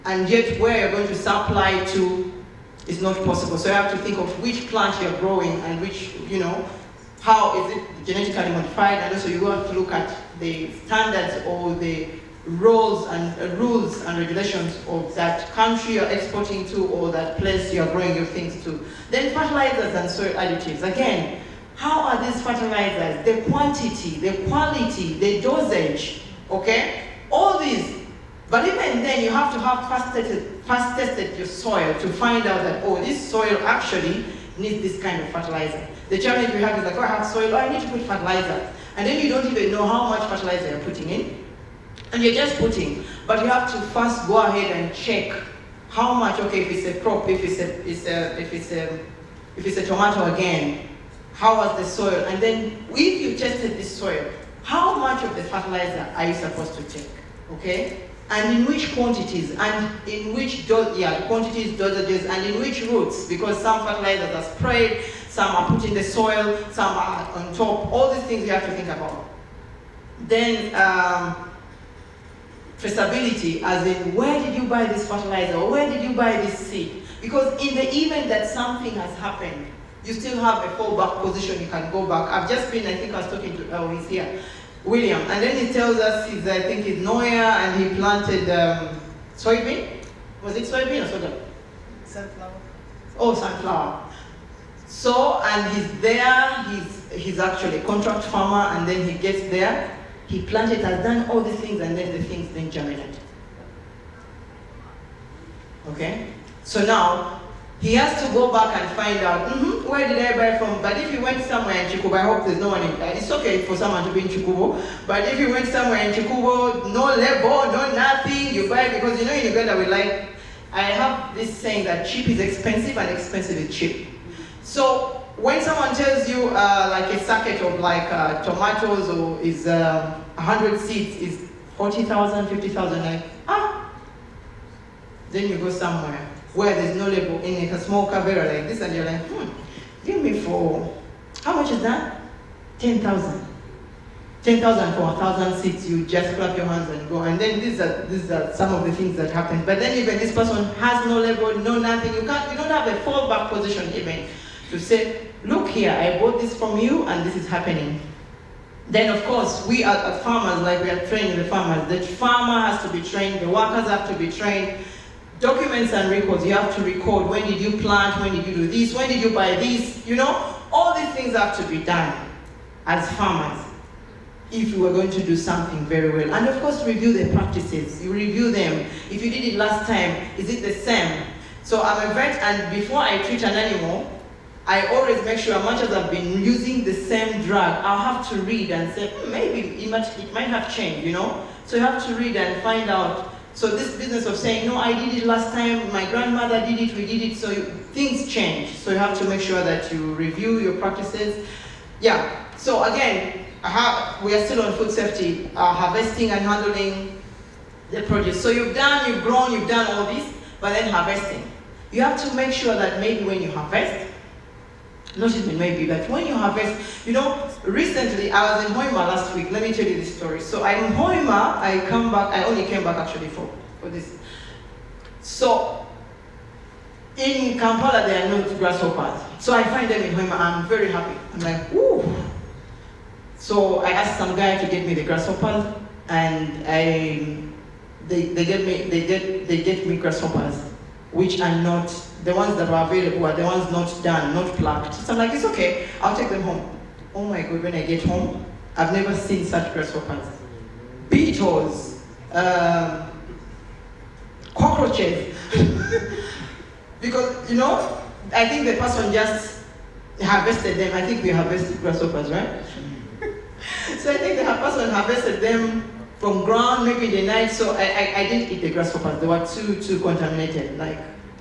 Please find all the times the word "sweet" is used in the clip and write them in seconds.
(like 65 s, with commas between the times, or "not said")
not said.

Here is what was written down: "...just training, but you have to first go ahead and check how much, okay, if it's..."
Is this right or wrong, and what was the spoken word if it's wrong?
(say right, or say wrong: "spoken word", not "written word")
wrong: "putting", not "training".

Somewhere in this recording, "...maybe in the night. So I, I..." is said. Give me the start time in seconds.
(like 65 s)
266 s.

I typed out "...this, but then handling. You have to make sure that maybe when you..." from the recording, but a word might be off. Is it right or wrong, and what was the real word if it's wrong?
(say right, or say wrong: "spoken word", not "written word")
wrong: "harvesting", not "handling".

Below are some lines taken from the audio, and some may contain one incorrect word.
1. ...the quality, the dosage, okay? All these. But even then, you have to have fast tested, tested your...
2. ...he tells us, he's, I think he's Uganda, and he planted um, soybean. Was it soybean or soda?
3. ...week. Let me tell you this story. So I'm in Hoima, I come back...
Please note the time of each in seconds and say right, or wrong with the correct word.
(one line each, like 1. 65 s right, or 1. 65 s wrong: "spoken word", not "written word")
1. 24 s right
2. 85 s wrong: "Nwoya", not "Uganda"
3. 219 s right.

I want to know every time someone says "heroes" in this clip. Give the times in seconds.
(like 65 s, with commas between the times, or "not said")
not said.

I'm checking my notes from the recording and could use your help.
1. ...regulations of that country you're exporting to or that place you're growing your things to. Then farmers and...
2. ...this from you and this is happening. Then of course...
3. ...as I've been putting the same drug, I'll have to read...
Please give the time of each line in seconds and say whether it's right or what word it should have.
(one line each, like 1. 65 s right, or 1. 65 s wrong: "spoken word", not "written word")
1. 14 s wrong: "fertilizers", not "farmers"
2. 156 s right
3. 185 s wrong: "using", not "putting".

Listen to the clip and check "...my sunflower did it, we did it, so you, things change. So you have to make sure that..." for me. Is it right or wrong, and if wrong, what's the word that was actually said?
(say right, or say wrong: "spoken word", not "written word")
wrong: "grandmother", not "sunflower".